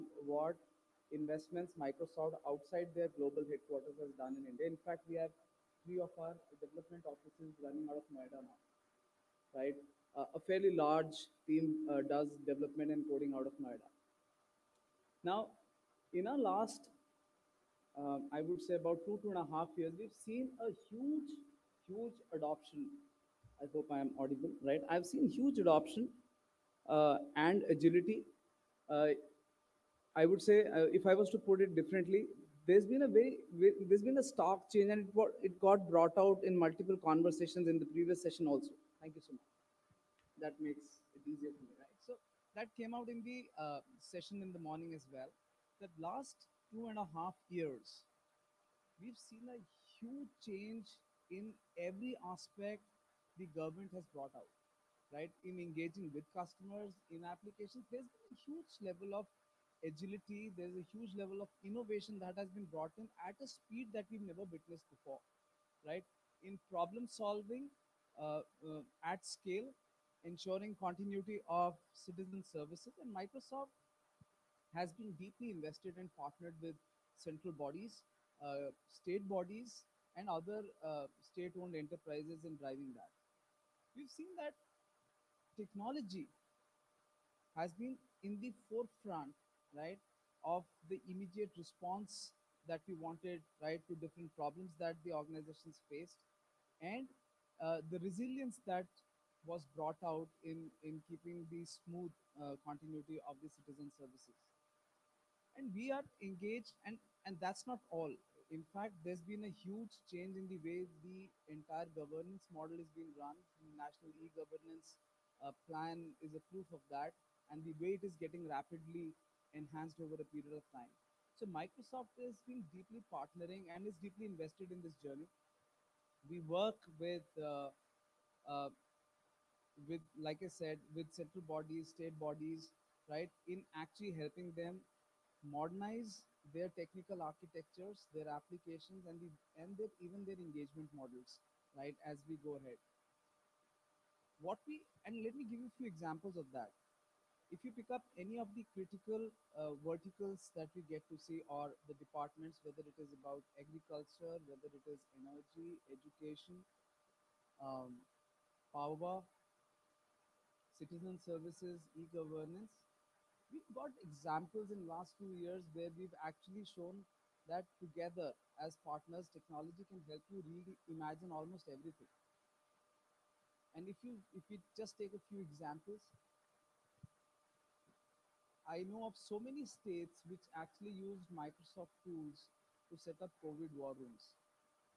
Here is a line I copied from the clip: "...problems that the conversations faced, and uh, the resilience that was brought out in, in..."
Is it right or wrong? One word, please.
wrong.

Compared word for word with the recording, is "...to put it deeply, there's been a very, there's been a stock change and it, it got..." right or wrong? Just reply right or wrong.
wrong.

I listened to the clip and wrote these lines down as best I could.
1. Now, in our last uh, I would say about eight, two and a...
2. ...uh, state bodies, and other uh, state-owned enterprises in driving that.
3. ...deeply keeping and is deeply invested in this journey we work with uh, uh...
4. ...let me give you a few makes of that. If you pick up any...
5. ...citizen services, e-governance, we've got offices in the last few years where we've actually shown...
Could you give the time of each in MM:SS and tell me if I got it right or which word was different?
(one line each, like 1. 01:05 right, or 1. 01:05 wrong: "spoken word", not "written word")
1. 00:15 wrong: "two", not "eight"
2. 01:18 right
3. 02:02 wrong: "partnering", not "keeping"
4. 02:25 wrong: "examples", not "makes"
5. 02:40 wrong: "examples", not "offices".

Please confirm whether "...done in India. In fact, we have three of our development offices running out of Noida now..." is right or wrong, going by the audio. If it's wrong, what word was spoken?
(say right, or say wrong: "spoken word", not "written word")
right.